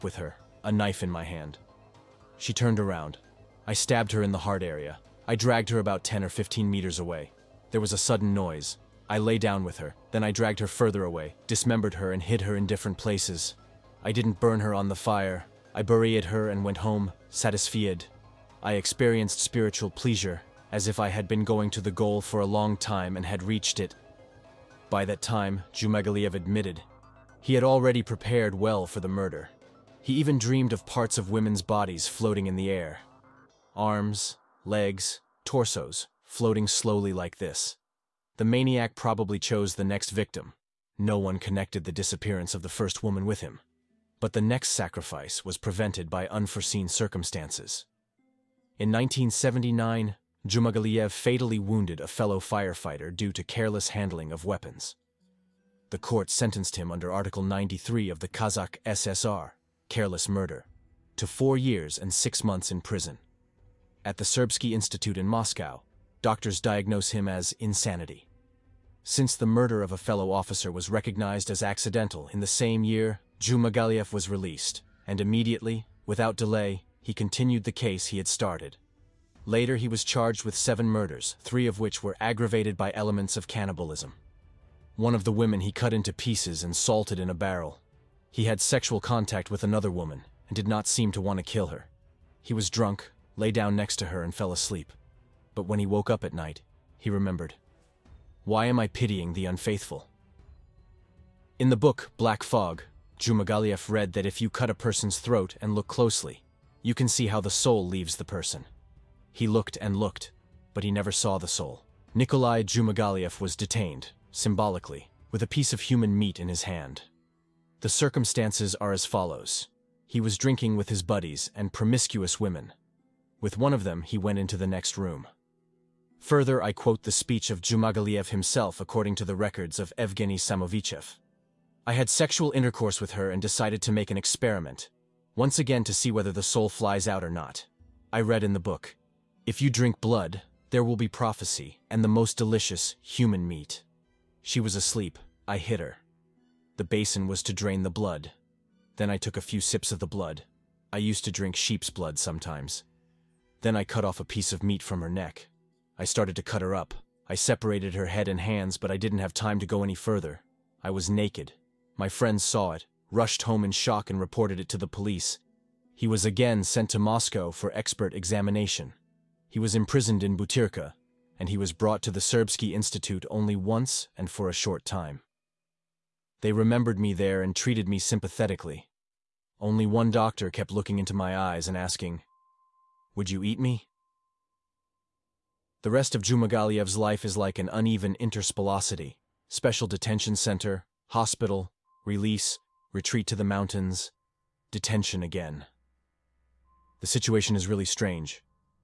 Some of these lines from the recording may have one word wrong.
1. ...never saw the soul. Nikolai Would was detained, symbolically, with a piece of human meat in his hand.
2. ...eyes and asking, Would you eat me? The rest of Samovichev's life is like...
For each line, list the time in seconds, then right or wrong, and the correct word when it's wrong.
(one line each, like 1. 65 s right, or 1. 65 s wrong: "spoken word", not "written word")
1. 110 s wrong: "Jumagaliev", not "Would"
2. 181 s wrong: "Jumagaliev", not "Samovichev".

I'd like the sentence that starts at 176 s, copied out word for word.
They remembered me there and treated me sympathetically.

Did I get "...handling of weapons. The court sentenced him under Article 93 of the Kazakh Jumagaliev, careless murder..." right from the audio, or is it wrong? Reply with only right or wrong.
wrong.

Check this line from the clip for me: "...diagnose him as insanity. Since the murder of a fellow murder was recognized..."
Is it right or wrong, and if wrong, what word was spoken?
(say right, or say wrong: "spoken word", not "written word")
wrong: "officer", not "murder".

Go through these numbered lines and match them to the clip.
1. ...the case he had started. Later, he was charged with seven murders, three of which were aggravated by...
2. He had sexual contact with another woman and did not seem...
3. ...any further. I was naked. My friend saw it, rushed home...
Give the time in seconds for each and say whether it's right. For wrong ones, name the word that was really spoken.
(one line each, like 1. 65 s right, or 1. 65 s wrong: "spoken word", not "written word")
1. 77 s right
2. 88 s right
3. 159 s right.